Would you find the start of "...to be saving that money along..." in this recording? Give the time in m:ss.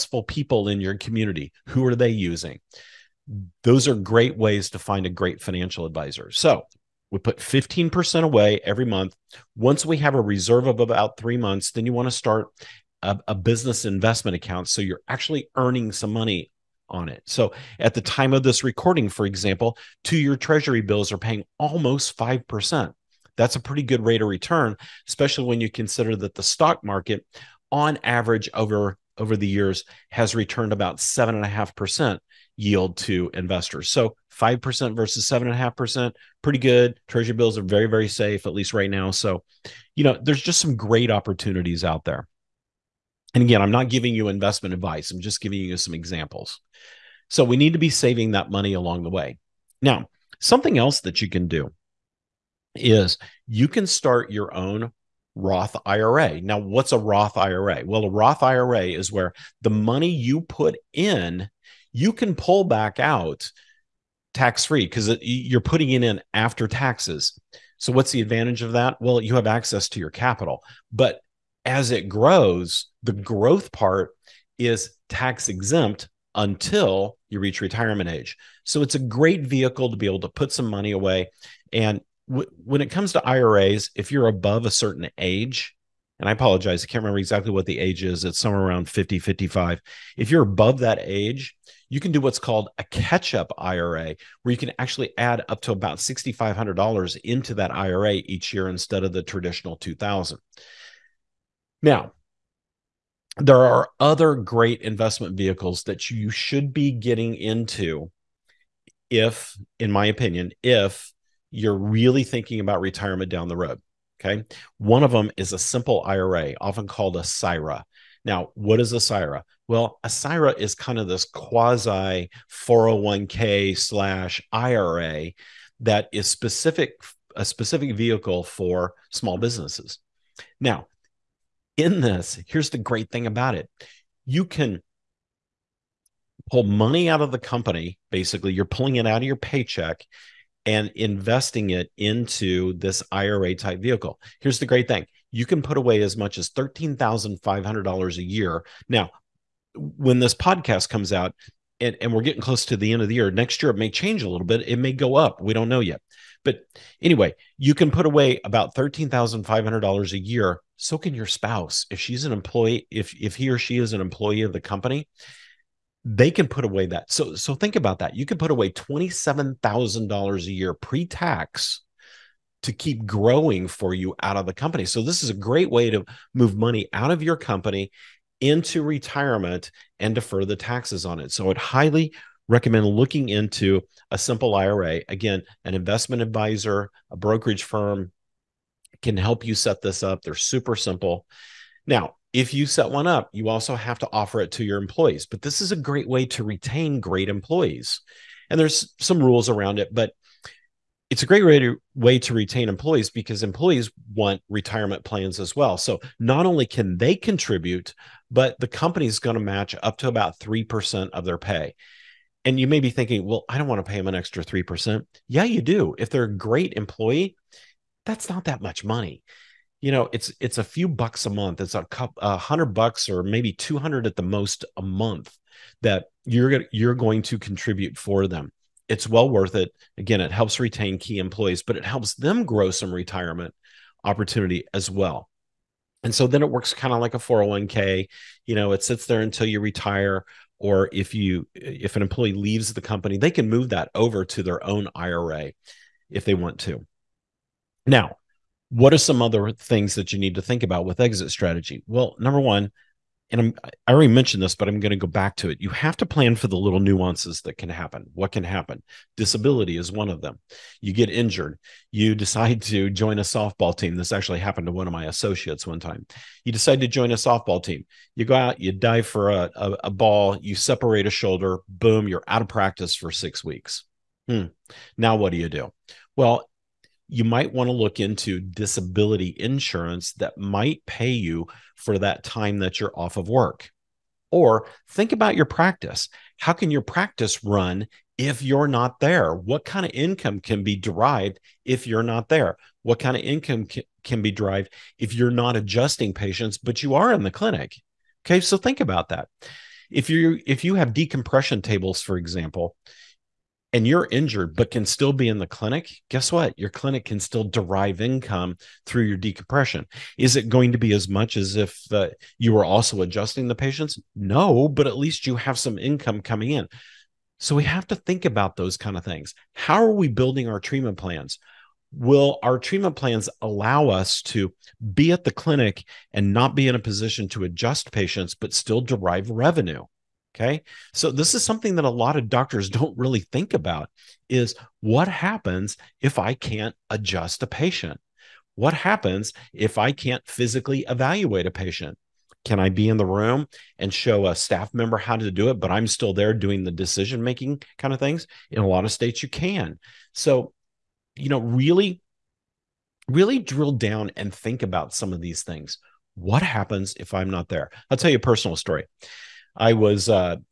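0:47.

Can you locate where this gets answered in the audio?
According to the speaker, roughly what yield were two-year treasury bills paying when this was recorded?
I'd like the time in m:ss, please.
0:21.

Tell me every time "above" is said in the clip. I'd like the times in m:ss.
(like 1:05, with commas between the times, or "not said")
1:24, 1:30.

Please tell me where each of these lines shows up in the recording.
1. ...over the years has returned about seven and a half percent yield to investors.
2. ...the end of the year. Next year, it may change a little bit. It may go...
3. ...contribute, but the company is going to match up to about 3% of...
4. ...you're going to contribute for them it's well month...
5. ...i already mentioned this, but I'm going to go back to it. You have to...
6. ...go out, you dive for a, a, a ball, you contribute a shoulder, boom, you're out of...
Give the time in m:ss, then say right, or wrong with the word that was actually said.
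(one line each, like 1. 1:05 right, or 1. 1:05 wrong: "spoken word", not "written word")
1. 0:29 right
2. 2:32 right
3. 3:27 right
4. 3:46 wrong: "worth", not "month"
5. 4:13 right
6. 4:28 wrong: "separate", not "contribute".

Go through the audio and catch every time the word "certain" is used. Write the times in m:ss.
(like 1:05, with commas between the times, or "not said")
1:24.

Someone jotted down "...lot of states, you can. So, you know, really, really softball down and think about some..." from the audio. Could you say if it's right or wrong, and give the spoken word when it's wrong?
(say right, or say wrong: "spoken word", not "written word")
wrong: "drill", not "softball".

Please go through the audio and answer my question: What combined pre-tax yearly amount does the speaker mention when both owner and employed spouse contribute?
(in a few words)
$27,000.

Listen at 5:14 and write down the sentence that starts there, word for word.
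No, but at least you have some income coming in.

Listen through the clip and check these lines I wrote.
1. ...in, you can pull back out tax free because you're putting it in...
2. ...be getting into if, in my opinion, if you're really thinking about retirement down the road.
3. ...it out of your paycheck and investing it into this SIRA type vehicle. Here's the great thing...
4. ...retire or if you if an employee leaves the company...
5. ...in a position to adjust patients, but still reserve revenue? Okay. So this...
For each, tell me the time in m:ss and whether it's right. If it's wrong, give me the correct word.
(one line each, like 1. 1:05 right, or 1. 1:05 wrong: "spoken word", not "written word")
1. 1:00 right
2. 1:46 right
3. 2:18 wrong: "IRA", not "SIRA"
4. 3:59 right
5. 5:26 wrong: "derive", not "reserve".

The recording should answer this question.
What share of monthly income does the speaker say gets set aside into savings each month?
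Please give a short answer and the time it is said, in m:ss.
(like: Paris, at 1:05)
15%, at 0:07.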